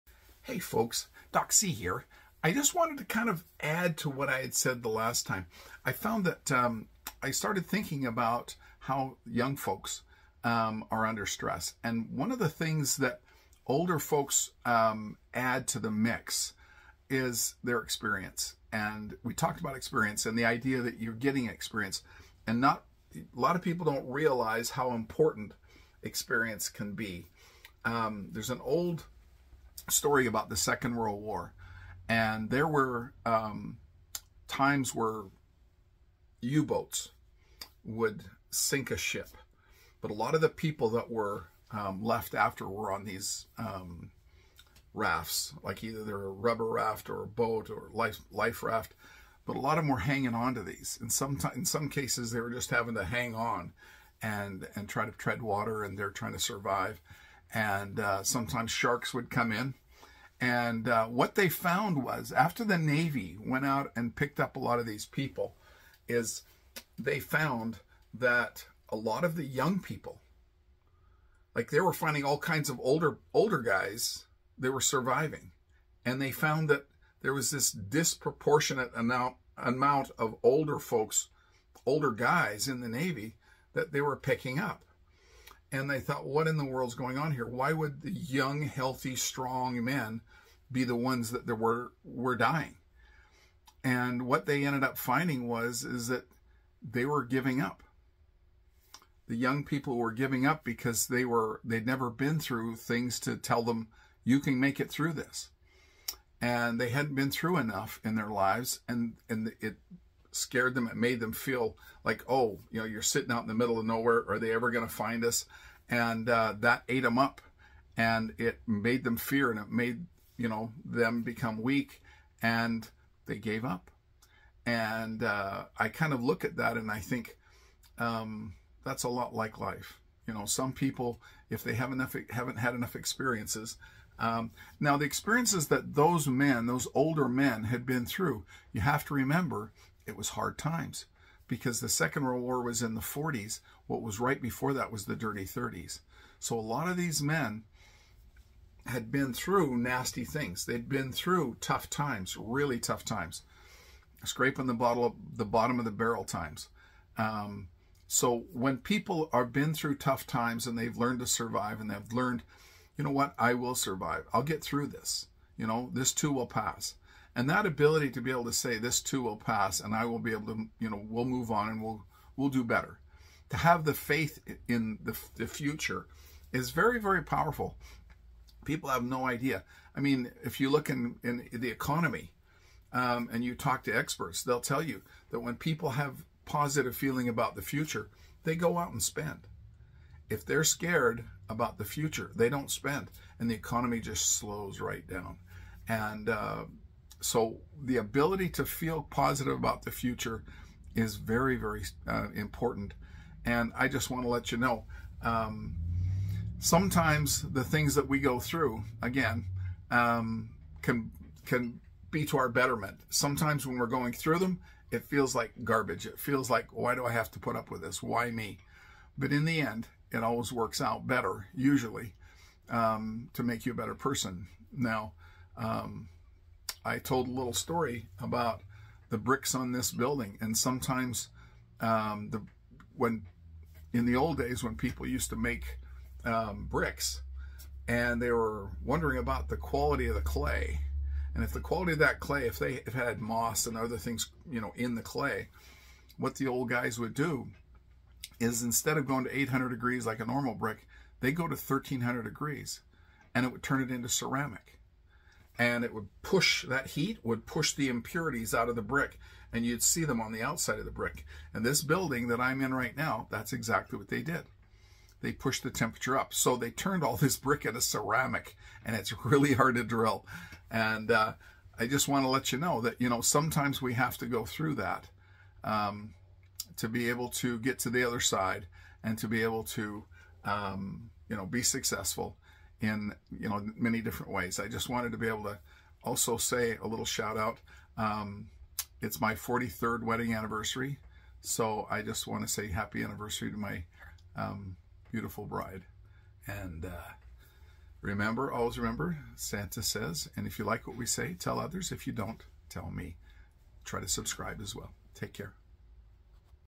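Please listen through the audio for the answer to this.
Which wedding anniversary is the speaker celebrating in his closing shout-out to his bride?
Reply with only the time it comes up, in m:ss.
4:49.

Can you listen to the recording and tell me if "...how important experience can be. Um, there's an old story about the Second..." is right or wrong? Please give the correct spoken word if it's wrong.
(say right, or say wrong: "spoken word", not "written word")
right.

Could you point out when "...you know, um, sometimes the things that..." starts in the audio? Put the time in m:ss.
3:24.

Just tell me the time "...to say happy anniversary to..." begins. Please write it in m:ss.
4:52.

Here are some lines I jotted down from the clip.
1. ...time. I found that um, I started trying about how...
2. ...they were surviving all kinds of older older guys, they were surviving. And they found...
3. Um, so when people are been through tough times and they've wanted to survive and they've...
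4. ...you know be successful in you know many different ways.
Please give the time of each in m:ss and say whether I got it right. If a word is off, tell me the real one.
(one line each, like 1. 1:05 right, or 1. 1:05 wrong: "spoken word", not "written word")
1. 0:05 wrong: "thinking", not "trying"
2. 1:11 wrong: "finding", not "surviving"
3. 2:37 wrong: "learned", not "wanted"
4. 4:41 right.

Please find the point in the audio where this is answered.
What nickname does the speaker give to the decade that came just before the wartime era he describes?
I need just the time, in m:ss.
2:25.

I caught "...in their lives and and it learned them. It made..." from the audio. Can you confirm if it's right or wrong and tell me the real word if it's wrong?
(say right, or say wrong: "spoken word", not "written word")
wrong: "scared", not "learned".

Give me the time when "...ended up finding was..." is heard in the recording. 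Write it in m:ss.
1:34.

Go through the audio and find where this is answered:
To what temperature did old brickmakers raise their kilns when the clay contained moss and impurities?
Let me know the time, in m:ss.
4:11.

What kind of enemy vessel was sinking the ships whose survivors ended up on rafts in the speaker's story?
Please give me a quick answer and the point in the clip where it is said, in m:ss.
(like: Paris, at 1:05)
U-boats, at 0:36.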